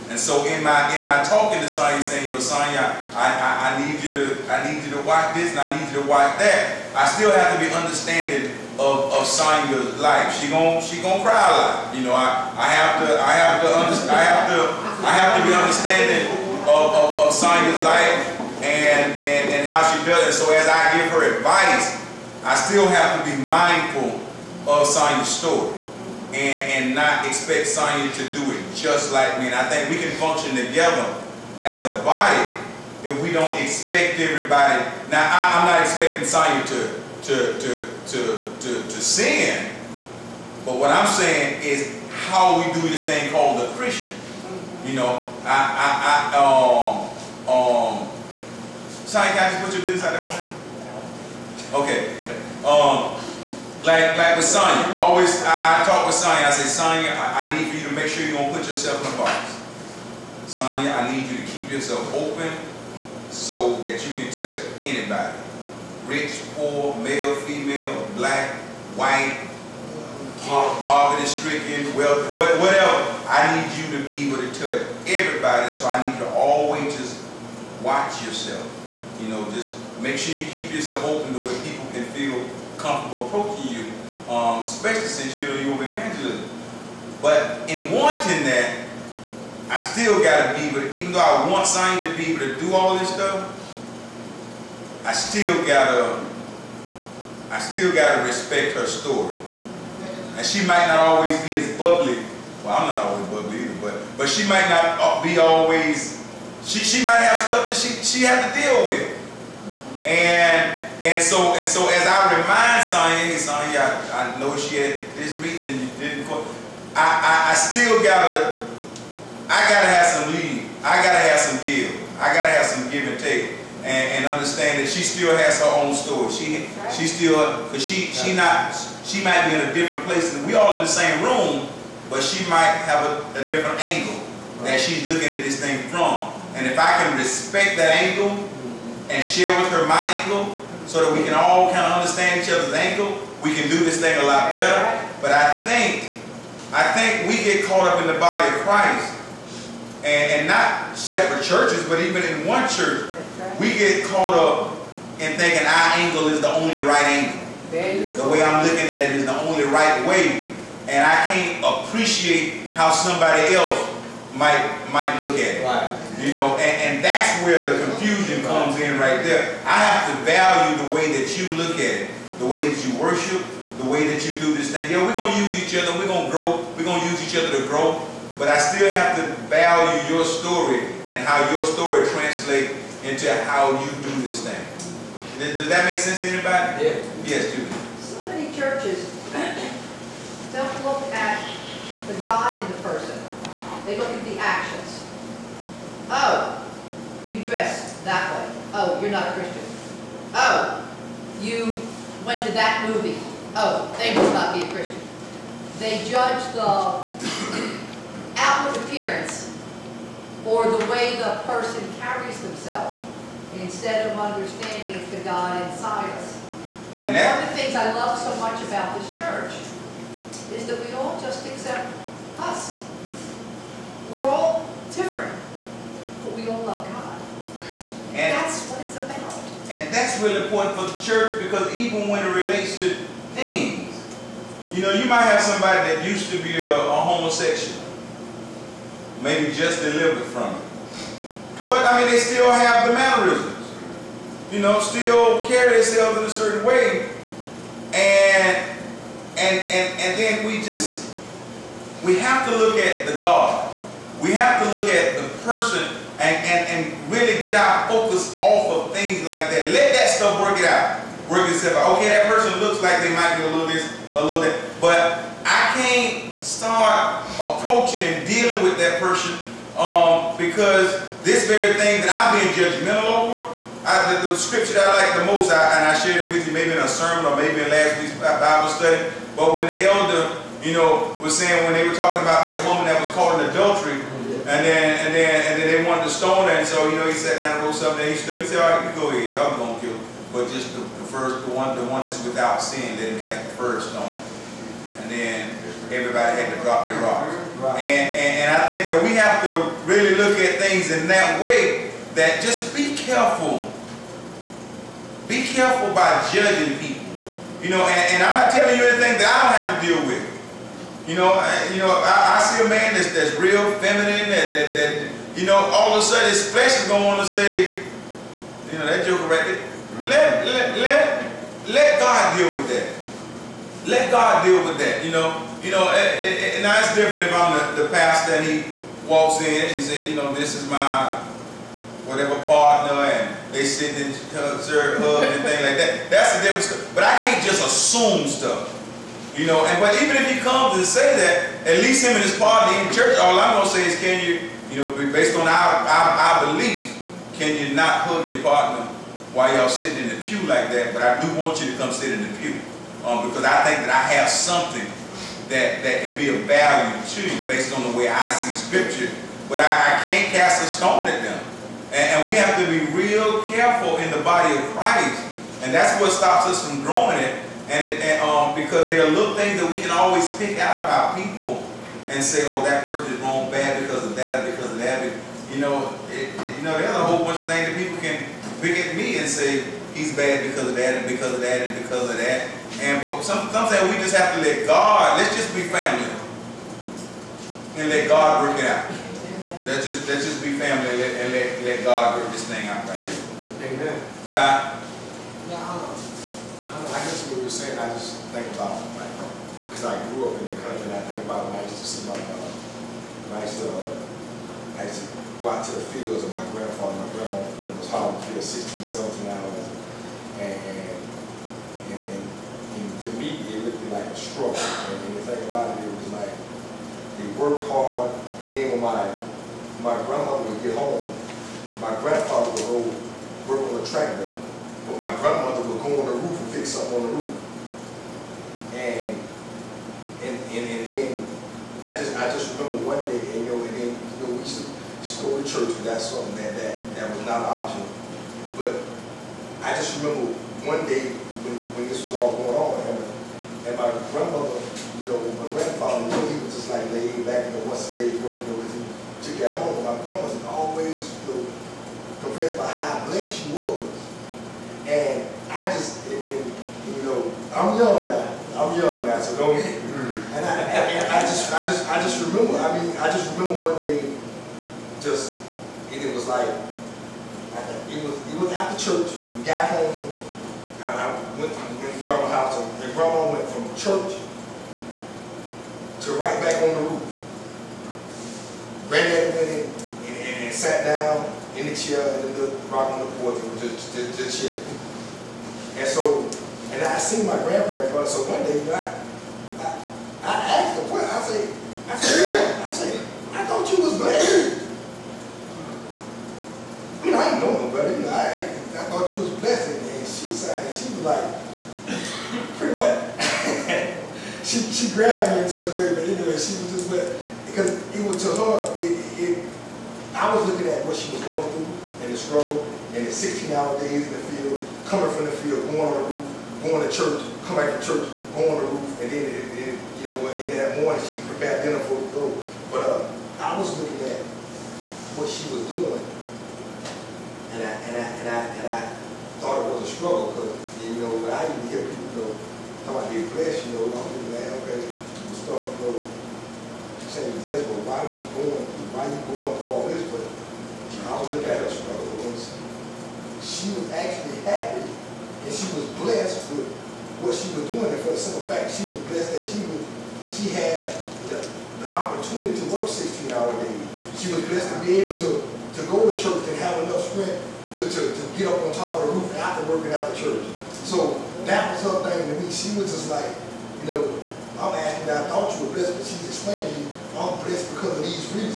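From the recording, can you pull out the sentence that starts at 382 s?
And but some, sometimes we just have to let God, let's just be family.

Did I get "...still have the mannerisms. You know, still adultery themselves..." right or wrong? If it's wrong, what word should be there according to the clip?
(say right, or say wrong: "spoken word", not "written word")
wrong: "carry", not "adultery".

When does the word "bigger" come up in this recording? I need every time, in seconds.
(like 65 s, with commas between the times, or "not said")
not said.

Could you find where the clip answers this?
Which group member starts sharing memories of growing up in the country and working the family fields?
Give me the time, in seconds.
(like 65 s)
394 s.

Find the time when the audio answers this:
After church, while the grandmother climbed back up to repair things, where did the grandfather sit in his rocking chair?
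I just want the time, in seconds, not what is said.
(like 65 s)
483 s.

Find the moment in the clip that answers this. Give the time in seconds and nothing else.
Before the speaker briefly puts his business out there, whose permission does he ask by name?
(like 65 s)
49 s.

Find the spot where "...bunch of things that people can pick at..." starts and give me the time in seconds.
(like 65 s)
377 s.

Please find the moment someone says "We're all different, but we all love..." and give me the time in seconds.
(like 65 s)
224 s.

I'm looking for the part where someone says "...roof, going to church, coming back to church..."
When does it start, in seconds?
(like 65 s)
516 s.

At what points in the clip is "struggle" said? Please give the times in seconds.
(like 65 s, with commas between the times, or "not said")
414 s, 512 s, 529 s, 541 s.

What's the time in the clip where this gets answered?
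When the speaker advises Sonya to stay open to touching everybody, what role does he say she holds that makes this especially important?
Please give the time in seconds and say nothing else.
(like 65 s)
85 s.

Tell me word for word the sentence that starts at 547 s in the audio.
And for the simple fact, she was blessed that she was, she had the, the opportunity to work 16 hour days.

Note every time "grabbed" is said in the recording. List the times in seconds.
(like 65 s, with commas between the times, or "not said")
504 s.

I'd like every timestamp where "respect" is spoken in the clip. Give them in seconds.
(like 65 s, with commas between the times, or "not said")
98 s, 137 s.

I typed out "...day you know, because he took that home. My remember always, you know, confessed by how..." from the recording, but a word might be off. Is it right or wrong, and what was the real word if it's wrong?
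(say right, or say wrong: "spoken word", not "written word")
wrong: "grandmother", not "remember".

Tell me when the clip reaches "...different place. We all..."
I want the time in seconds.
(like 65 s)
129 s.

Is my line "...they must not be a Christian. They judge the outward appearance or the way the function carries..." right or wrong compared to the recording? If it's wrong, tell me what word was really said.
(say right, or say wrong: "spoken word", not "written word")
wrong: "person", not "function".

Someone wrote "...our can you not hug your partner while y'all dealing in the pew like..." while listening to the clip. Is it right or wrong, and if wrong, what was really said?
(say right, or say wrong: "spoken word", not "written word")
wrong: "sitting", not "dealing".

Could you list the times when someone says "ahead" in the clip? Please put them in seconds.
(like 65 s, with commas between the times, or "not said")
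289 s.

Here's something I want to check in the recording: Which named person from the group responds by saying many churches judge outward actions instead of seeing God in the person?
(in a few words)
Judy.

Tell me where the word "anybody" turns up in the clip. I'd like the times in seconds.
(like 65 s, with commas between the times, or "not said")
64 s, 186 s.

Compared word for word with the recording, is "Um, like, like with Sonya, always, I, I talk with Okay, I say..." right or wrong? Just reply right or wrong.
wrong.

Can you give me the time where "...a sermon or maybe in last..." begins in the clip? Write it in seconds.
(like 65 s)
276 s.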